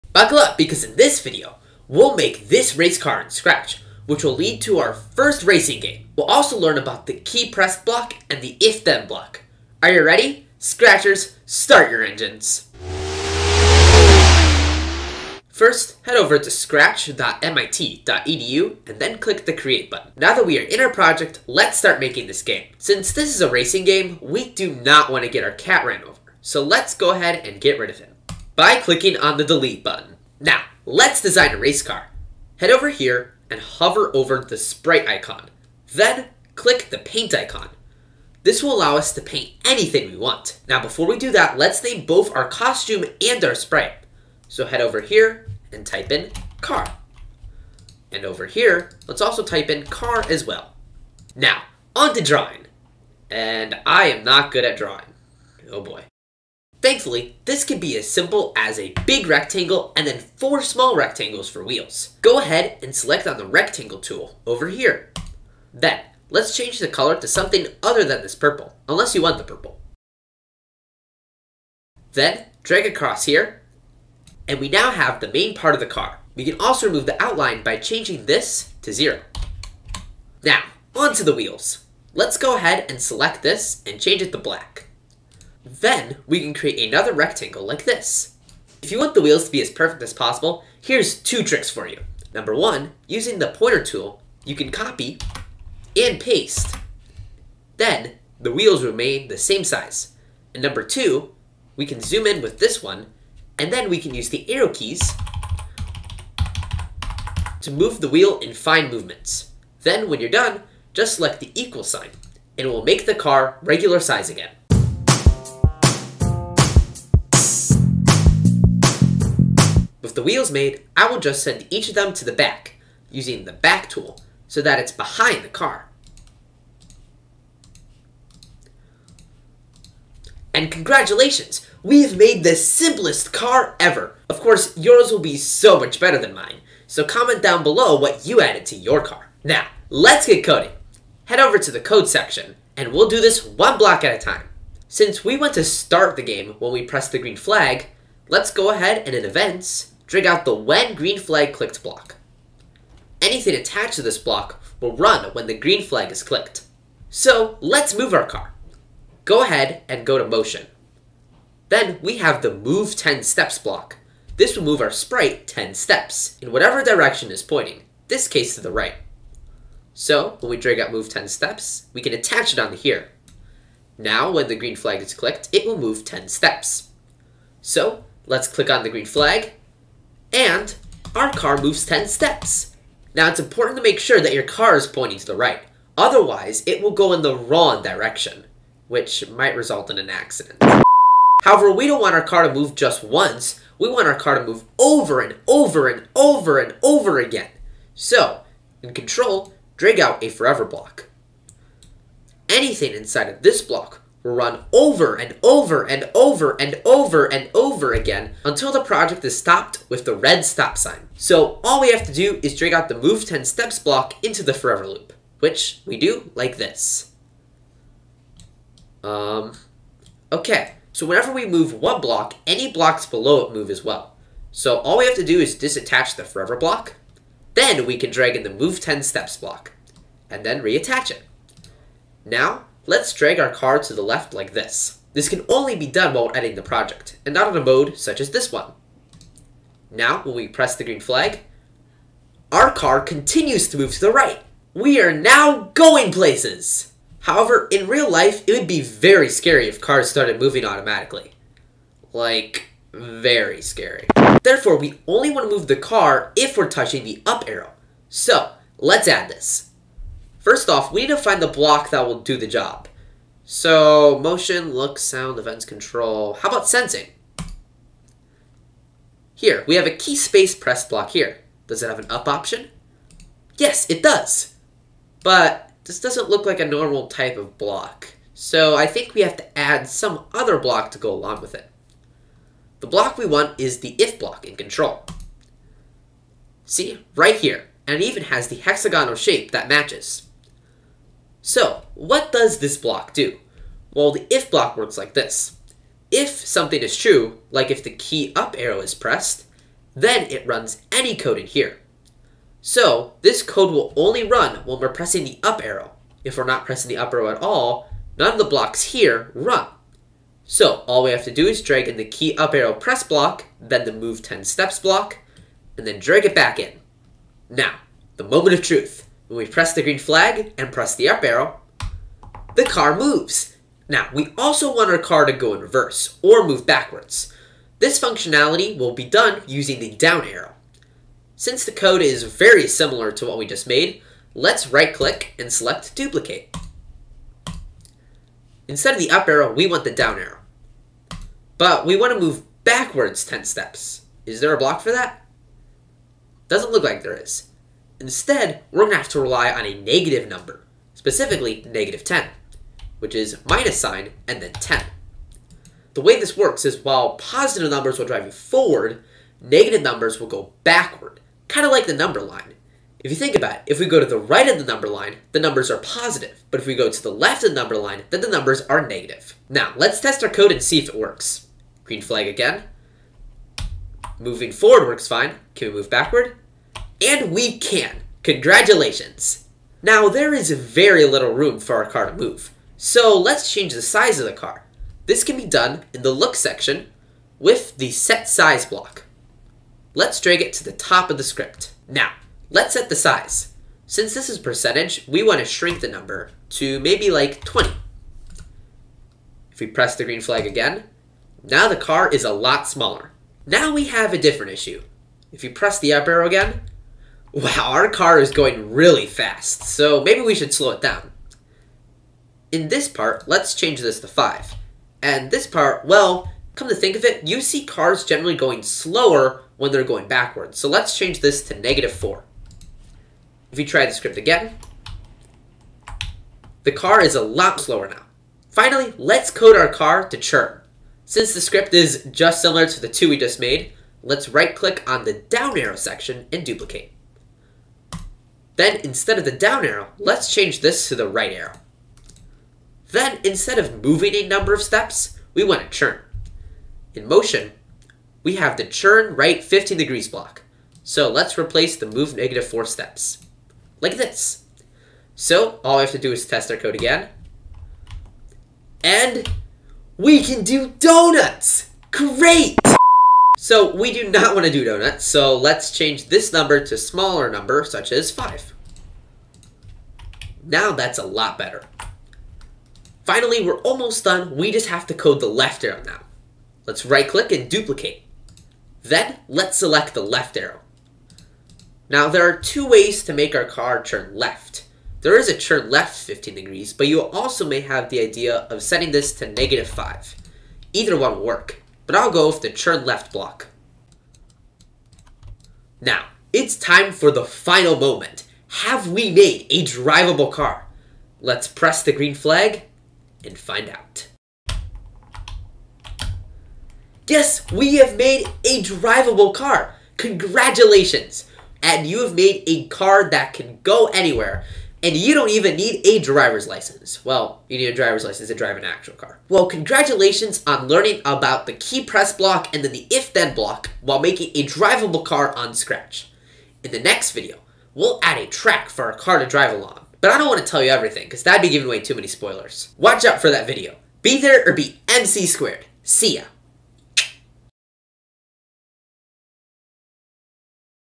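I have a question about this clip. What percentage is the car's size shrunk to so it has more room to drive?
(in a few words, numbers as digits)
20.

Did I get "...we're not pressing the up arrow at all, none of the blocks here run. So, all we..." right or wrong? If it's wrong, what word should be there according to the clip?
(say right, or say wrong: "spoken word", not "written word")
right.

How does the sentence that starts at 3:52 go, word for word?
Now, Let's drag our car to the left like this.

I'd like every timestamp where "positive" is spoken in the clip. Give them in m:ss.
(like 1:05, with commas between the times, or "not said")
5:57, 6:05.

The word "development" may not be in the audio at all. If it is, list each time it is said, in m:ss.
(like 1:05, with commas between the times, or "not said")
not said.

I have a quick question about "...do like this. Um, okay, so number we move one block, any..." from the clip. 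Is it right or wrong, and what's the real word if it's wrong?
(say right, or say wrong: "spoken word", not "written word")
wrong: "whenever", not "number".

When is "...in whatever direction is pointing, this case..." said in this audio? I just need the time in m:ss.
2:46.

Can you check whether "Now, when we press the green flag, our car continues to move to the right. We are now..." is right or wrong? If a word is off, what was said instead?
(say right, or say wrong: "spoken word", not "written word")
right.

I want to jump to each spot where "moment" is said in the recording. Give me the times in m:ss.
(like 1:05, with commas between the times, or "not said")
5:18, 8:17.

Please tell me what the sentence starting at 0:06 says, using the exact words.
We'll also learn about the key press block and the if-then block.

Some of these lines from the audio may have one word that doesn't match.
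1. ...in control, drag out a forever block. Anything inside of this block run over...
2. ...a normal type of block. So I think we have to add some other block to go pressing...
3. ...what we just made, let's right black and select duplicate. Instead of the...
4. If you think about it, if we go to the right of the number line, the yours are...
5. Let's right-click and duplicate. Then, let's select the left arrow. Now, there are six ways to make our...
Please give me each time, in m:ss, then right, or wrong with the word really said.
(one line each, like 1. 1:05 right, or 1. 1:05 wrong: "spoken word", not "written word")
1. 3:18 right
2. 4:36 wrong: "along", not "pressing"
3. 5:33 wrong: "click", not "black"
4. 6:03 wrong: "numbers", not "yours"
5. 7:56 wrong: "two", not "six".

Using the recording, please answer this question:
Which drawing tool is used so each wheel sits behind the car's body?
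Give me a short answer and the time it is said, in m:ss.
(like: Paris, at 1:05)
the back tool, at 2:03.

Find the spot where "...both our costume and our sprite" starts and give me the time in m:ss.
0:42.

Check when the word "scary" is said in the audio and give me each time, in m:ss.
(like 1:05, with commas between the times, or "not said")
4:09, 4:13.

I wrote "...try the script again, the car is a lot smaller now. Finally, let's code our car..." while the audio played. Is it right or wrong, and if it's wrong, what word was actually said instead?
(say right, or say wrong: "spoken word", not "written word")
wrong: "slower", not "smaller".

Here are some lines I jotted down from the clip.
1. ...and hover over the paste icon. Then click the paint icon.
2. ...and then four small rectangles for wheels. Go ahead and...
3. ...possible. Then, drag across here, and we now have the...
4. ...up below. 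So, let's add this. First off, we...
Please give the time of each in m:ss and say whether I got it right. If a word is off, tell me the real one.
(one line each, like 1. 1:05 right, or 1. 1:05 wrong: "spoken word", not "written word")
1. 0:33 wrong: "sprite", not "paste"
2. 0:59 right
3. 1:09 wrong: "purple", not "possible"
4. 4:17 wrong: "arrow", not "below".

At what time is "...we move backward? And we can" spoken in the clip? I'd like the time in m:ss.
6:15.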